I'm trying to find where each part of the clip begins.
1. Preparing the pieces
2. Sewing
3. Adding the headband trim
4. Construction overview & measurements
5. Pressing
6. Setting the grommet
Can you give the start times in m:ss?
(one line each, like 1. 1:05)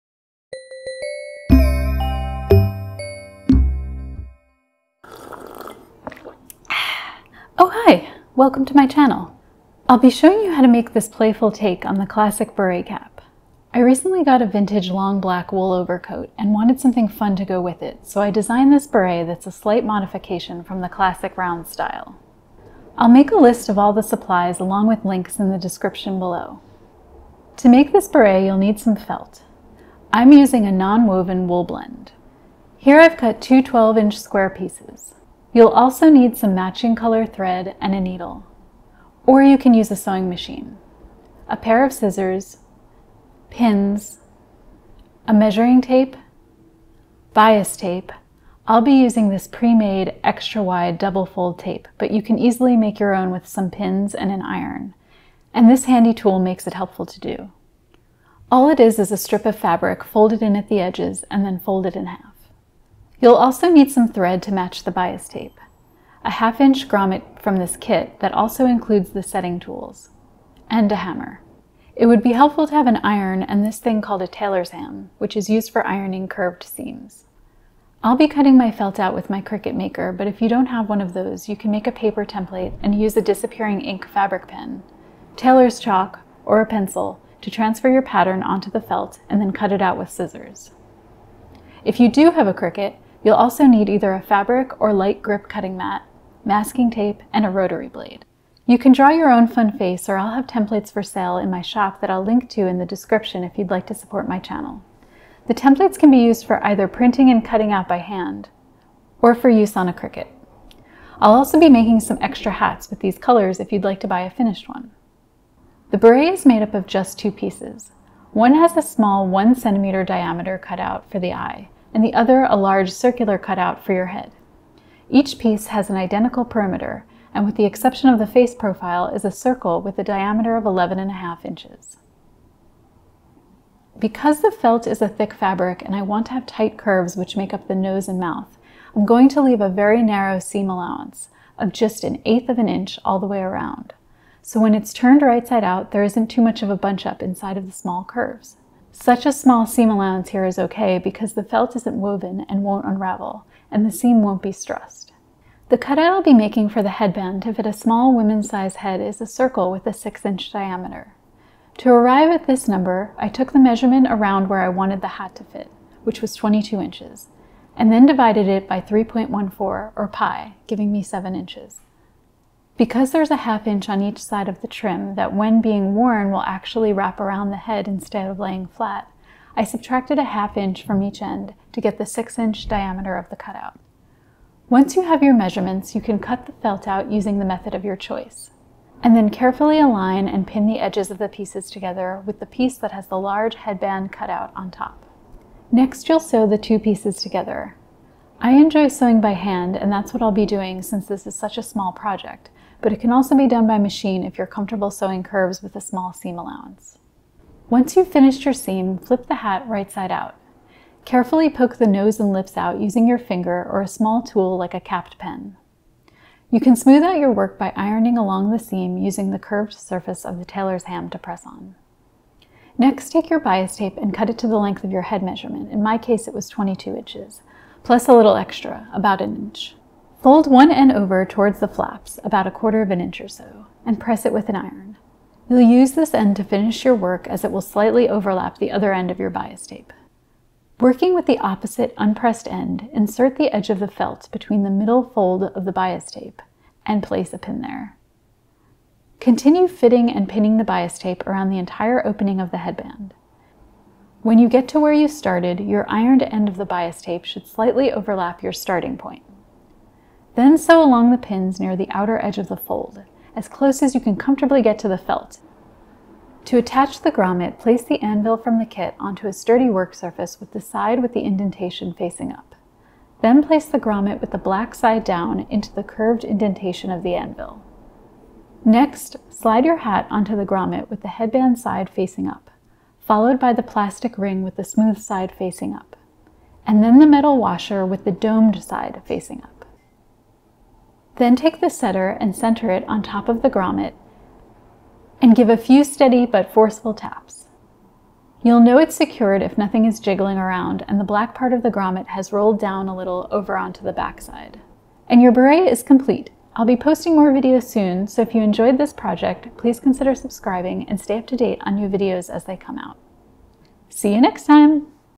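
1. 3:04
2. 3:15
3. 3:42
4. 1:55
5. 3:27
6. 4:26.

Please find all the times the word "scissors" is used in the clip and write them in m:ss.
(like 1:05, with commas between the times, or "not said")
0:41, 1:30.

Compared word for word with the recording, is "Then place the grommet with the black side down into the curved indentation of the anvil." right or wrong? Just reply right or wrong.
right.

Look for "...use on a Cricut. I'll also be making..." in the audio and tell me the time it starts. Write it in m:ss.
1:49.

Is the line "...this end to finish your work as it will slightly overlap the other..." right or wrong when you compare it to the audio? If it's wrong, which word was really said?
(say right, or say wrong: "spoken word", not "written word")
right.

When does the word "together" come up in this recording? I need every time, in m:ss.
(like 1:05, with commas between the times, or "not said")
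3:11, 3:17.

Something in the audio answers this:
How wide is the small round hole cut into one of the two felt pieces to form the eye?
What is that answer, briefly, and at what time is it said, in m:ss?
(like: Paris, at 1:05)
1 centimeter, at 1:59.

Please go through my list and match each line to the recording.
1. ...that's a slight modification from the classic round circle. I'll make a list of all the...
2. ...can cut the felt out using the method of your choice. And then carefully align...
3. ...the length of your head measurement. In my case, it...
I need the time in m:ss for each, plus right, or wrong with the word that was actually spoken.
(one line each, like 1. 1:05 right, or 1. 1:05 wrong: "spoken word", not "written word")
1. 0:19 wrong: "style", not "circle"
2. 3:06 right
3. 3:44 right.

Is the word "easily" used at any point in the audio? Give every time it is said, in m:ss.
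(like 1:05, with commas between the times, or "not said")
0:52.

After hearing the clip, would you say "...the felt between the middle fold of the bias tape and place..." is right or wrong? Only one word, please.
right.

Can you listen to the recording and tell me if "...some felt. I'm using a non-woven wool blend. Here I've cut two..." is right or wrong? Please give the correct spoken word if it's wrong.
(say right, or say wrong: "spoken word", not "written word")
right.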